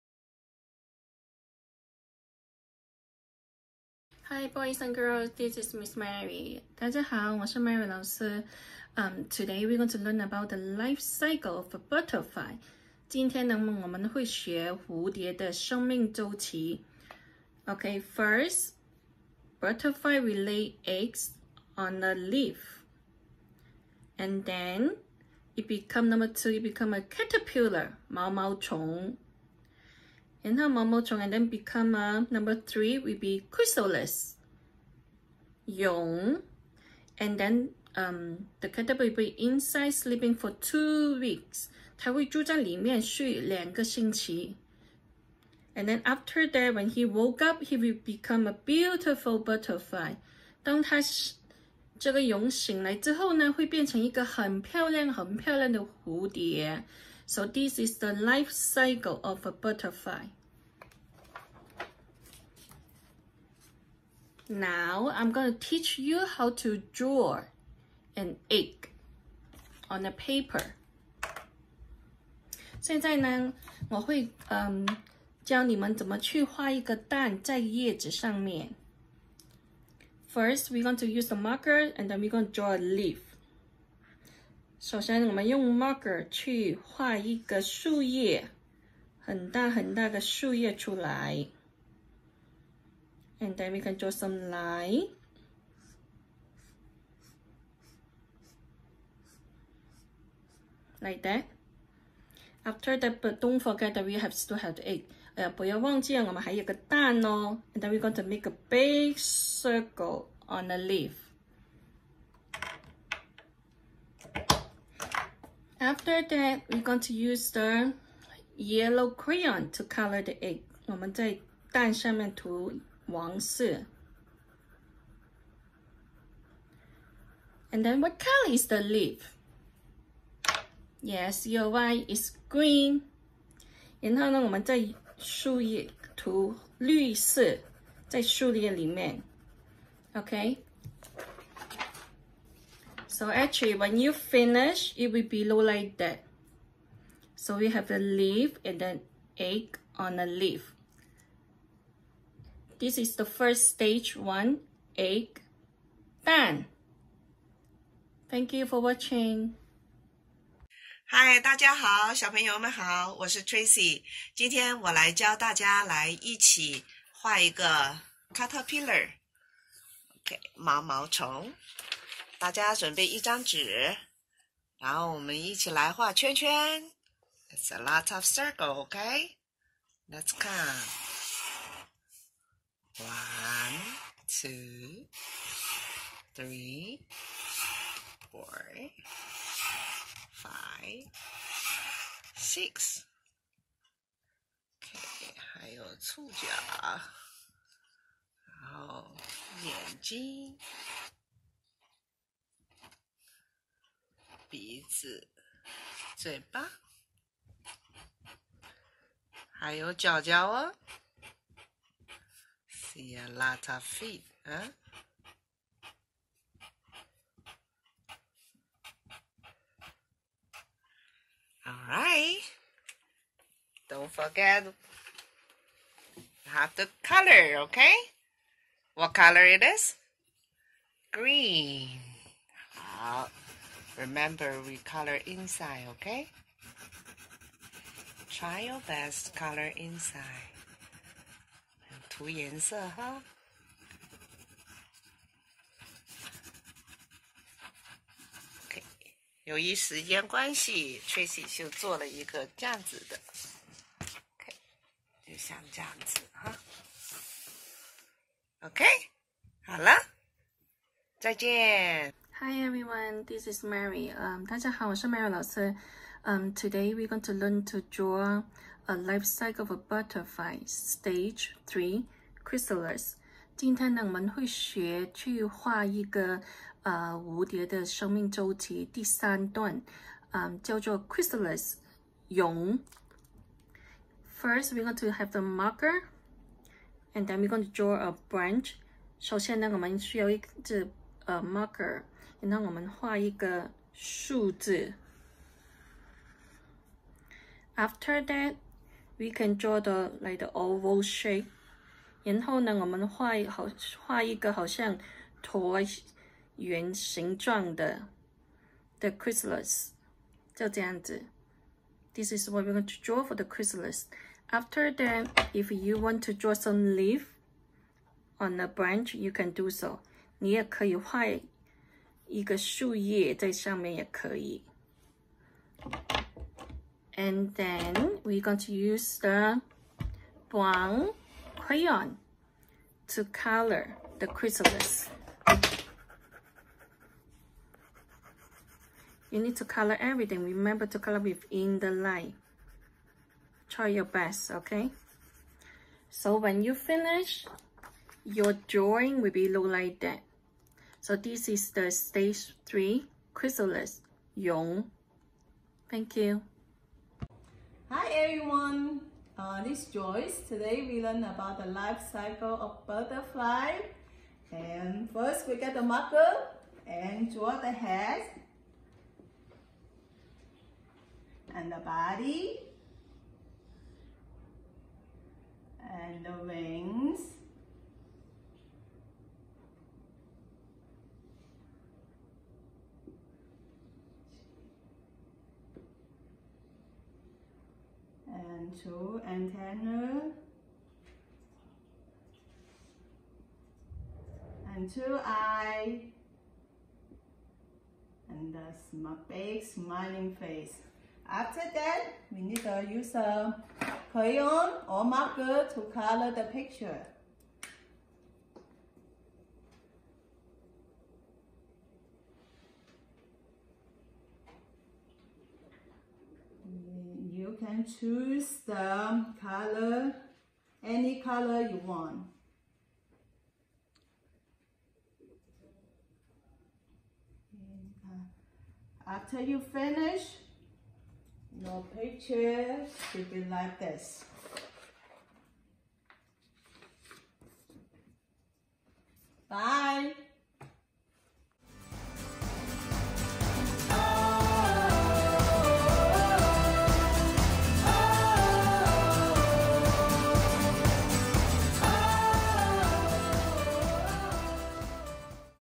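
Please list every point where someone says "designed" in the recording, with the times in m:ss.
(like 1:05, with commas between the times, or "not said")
not said.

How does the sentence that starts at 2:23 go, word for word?
So actually, when you finish, it will be look like that.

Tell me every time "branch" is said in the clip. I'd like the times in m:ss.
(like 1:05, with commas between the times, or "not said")
4:48, 5:18.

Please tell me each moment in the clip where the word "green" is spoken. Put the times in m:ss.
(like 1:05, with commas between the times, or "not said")
2:12, 3:51.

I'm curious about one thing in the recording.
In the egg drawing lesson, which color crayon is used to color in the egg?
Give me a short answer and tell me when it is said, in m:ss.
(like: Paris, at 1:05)
yellow, at 1:58.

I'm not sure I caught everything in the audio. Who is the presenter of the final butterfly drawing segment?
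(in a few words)
Joyce.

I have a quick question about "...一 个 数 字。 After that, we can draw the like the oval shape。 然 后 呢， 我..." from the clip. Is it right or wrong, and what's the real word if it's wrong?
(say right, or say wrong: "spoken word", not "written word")
right.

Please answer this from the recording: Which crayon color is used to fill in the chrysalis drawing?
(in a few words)
brown.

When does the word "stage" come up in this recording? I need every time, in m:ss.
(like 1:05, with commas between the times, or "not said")
2:33, 4:30, 5:51.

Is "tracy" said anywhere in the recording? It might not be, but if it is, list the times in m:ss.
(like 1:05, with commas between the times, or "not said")
2:43, 4:11.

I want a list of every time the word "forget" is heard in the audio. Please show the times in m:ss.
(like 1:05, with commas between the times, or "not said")
1:43, 3:44.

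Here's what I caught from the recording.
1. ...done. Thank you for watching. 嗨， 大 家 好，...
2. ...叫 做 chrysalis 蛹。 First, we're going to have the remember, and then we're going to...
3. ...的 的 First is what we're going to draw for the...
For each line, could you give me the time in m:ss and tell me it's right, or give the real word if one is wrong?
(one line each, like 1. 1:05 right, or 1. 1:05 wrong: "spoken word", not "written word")
1. 2:36 right
2. 4:40 wrong: "marker", not "remember"
3. 5:07 wrong: "This", not "First".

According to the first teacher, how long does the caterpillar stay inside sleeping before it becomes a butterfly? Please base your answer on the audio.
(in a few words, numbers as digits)
2 weeks.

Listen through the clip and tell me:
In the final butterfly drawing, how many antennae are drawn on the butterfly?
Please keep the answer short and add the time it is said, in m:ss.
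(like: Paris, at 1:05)
2, at 6:28.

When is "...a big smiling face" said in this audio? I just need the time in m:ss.
6:38.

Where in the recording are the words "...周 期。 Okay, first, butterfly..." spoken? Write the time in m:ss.
0:16.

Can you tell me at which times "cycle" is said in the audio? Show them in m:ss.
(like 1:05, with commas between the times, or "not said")
0:11, 0:58, 4:29, 6:02.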